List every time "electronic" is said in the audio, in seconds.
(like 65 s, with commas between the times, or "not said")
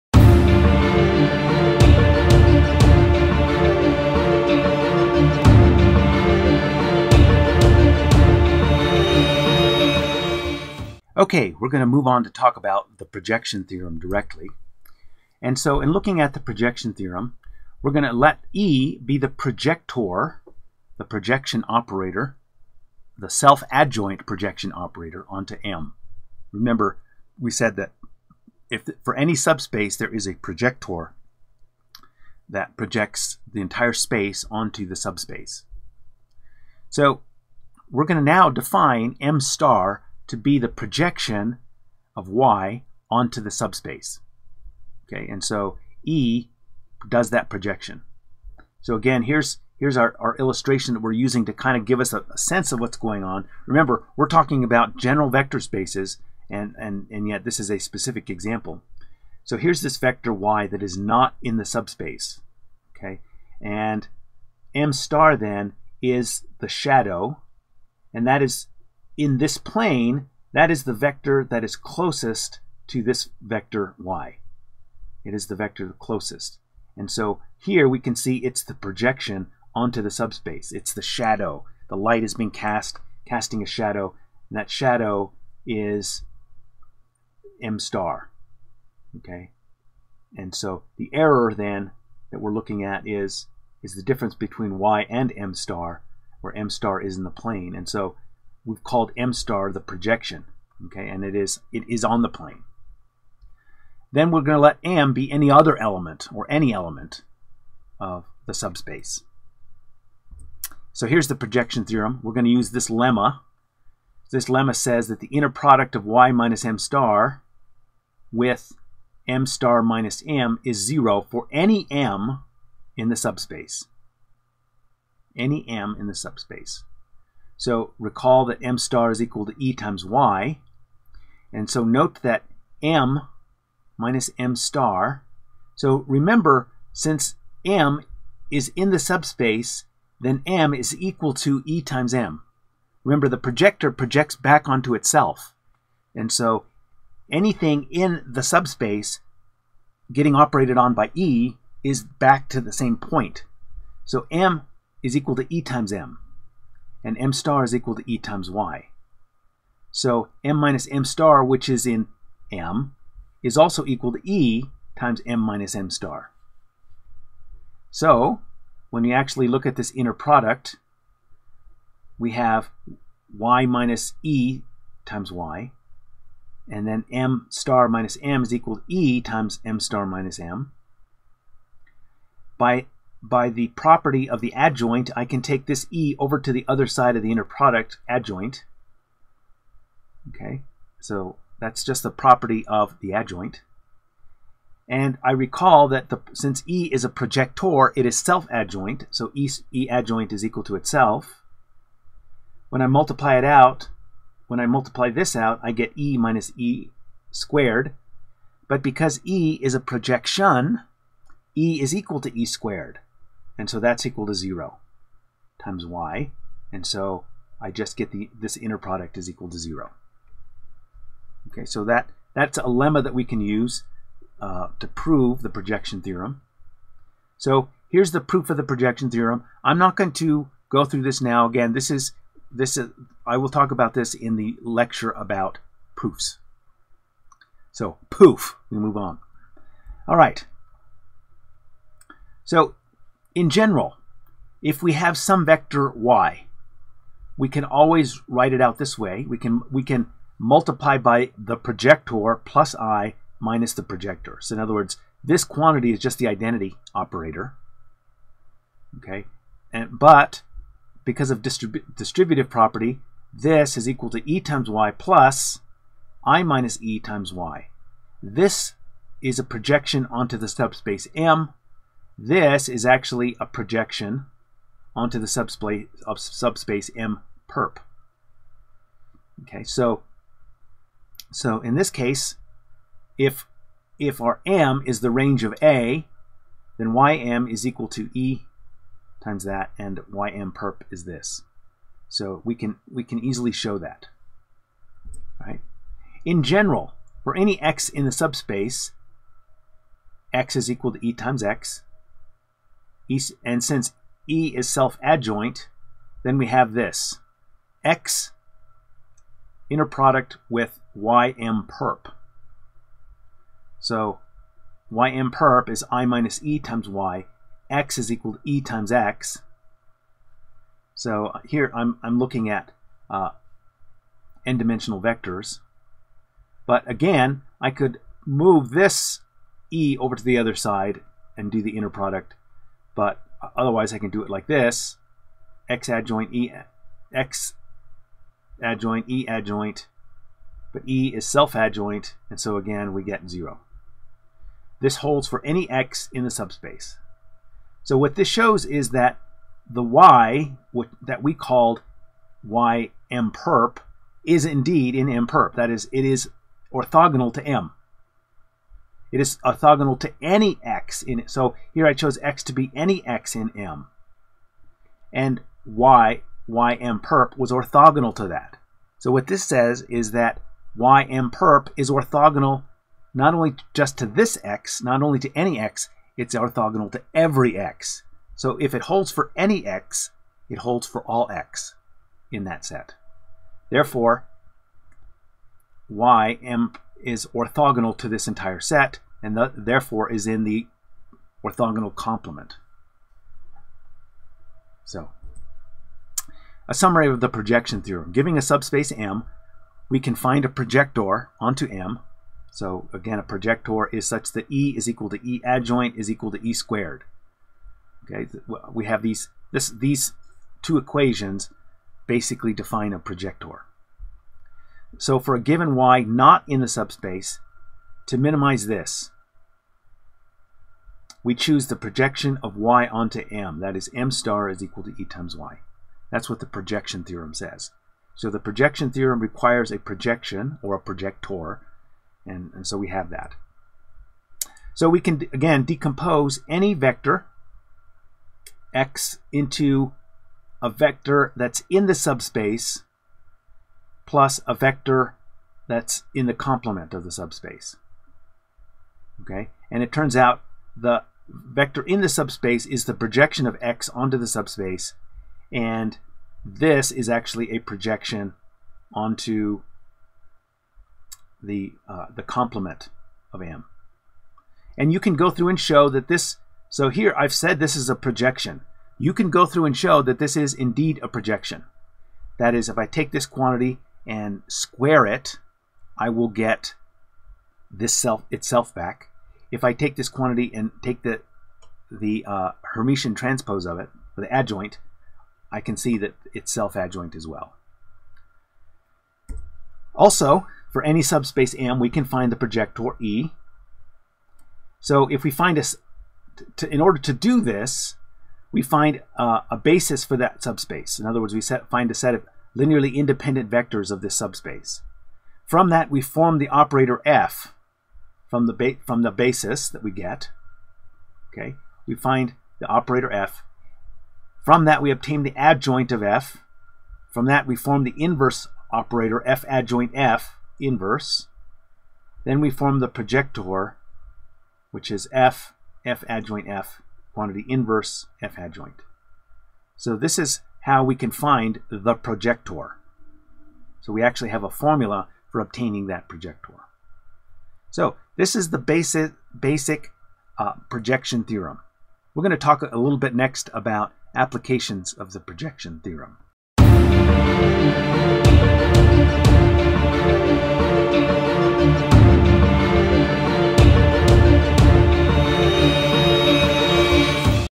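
not said.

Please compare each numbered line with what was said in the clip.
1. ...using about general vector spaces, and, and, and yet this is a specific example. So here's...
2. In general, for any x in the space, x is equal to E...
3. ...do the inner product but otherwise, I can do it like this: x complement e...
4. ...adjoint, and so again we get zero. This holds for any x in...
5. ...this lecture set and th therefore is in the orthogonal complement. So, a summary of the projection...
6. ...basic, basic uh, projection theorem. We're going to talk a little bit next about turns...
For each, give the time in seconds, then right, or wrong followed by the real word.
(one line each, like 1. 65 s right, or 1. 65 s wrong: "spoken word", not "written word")
1. 54 s wrong: "talking", not "using"
2. 296 s wrong: "subspace", not "space"
3. 331 s wrong: "adjoint", not "complement"
4. 341 s right
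5. 388 s wrong: "entire", not "lecture"
6. 538 s wrong: "applications", not "turns".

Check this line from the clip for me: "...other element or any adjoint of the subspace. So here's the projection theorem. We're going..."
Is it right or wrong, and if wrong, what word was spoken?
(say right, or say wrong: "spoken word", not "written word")
wrong: "element", not "adjoint".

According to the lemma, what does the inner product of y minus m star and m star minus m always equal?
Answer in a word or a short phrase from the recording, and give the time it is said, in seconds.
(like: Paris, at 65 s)
0, at 120 s.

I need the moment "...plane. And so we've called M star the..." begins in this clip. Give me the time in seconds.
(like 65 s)
97 s.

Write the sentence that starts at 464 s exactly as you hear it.
And you can go through and show that this.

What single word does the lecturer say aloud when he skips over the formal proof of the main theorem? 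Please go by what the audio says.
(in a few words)
Poof.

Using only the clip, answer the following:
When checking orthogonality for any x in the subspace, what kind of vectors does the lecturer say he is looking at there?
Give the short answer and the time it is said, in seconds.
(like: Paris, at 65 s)
n-dimensional vectors, at 324 s.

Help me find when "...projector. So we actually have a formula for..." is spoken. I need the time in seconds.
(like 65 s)
531 s.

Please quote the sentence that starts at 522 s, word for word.
Then we form the projector, which is f, f adjoint f, quantity inverse f adjoint.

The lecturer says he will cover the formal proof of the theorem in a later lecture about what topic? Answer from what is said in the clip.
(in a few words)
Proofs.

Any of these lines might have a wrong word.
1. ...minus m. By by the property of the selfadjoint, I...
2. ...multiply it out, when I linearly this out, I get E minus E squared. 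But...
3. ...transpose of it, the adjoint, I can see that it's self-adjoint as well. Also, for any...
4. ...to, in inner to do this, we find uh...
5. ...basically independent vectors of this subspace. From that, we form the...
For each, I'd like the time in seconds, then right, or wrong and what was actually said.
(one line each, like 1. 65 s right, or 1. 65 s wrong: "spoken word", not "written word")
1. 180 s wrong: "adjoint", not "selfadjoint"
2. 202 s wrong: "multiply", not "linearly"
3. 483 s right
4. 496 s wrong: "order", not "inner"
5. 502 s wrong: "linearly", not "basically".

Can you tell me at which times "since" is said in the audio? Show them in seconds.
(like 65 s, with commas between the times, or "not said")
136 s, 196 s, 303 s.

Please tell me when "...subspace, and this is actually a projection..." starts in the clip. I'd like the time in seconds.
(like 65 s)
454 s.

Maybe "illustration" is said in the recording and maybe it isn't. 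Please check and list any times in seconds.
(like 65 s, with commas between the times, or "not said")
50 s.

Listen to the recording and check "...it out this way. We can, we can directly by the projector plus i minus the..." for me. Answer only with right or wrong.
wrong.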